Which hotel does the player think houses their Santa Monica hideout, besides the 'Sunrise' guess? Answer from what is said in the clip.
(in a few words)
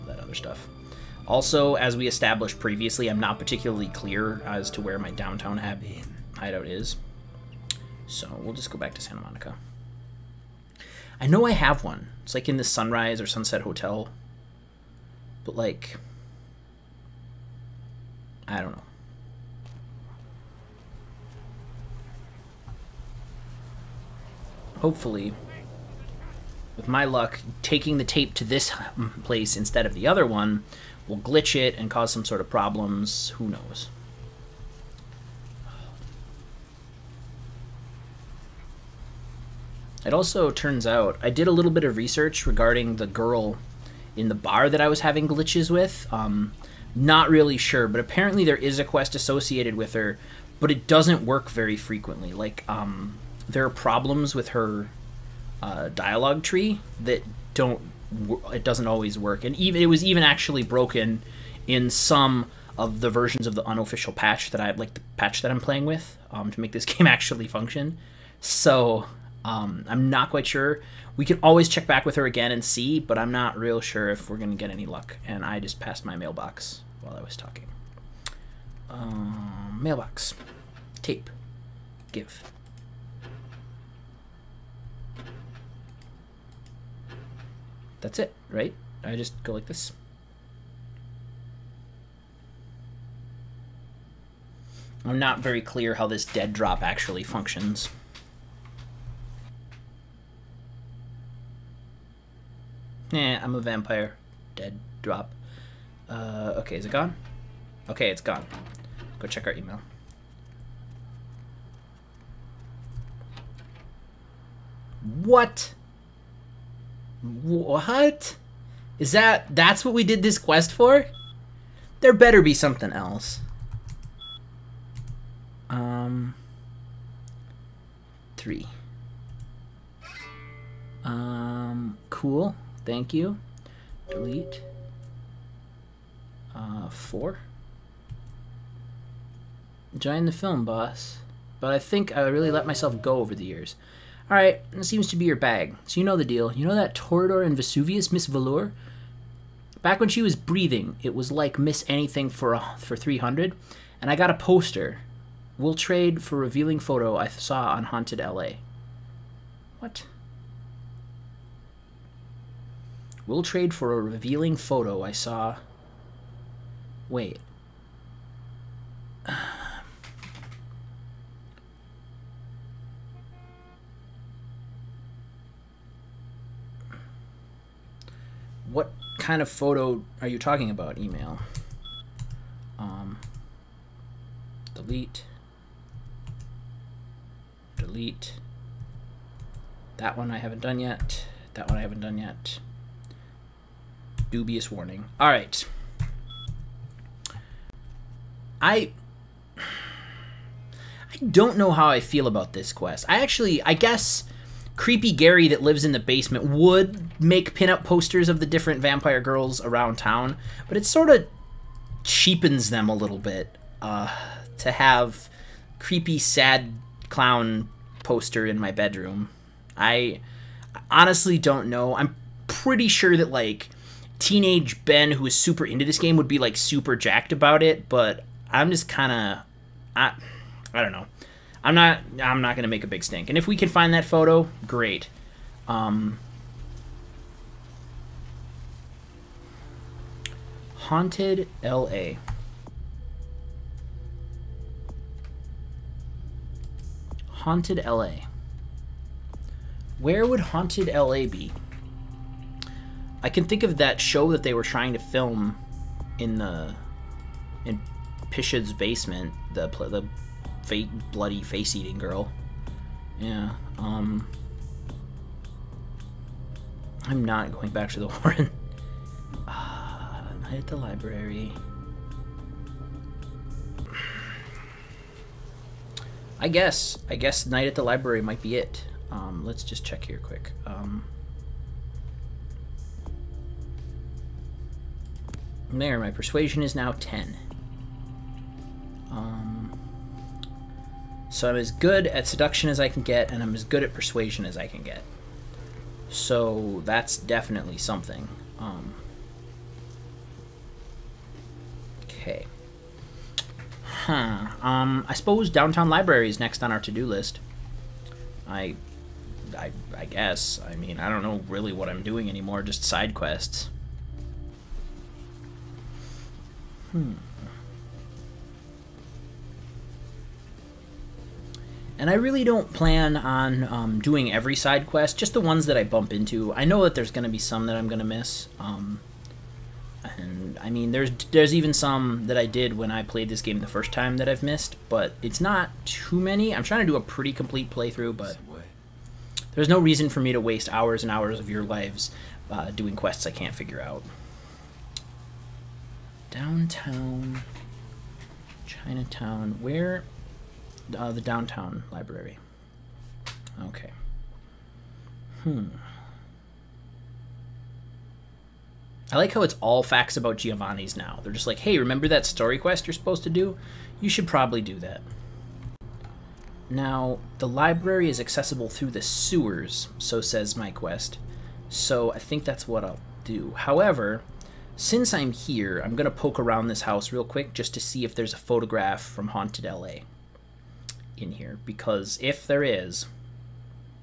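Sunset Hotel.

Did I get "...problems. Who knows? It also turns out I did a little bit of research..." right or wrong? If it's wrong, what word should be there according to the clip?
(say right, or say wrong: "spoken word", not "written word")
right.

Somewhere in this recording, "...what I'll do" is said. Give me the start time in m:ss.
6:12.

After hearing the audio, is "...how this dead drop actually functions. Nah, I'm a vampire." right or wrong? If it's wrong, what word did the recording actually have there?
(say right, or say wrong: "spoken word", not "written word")
right.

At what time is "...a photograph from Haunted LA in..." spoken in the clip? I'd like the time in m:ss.
6:18.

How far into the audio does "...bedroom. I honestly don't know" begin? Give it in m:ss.
3:38.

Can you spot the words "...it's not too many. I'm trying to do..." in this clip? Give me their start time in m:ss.
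5:35.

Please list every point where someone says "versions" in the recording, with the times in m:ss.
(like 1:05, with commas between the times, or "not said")
1:03.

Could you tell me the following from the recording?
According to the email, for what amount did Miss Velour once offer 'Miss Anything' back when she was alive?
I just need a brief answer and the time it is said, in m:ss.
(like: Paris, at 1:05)
300, at 2:32.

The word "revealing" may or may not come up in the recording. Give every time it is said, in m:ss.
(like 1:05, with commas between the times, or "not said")
2:36, 2:43.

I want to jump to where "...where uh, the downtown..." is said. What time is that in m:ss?
5:49.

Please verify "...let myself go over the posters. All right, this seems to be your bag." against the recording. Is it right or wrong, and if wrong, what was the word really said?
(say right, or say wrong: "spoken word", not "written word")
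wrong: "years", not "posters".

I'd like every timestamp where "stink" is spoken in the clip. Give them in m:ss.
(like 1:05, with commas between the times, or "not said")
3:53.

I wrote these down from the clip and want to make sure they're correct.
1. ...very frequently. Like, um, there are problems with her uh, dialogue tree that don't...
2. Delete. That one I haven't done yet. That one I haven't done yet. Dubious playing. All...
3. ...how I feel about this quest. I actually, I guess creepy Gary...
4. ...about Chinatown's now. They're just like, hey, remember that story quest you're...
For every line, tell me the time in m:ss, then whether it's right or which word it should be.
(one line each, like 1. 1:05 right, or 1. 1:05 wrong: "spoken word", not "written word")
1. 0:51 right
2. 3:07 wrong: "warning", not "playing"
3. 3:21 right
4. 6:00 wrong: "Giovanni", not "Chinatown".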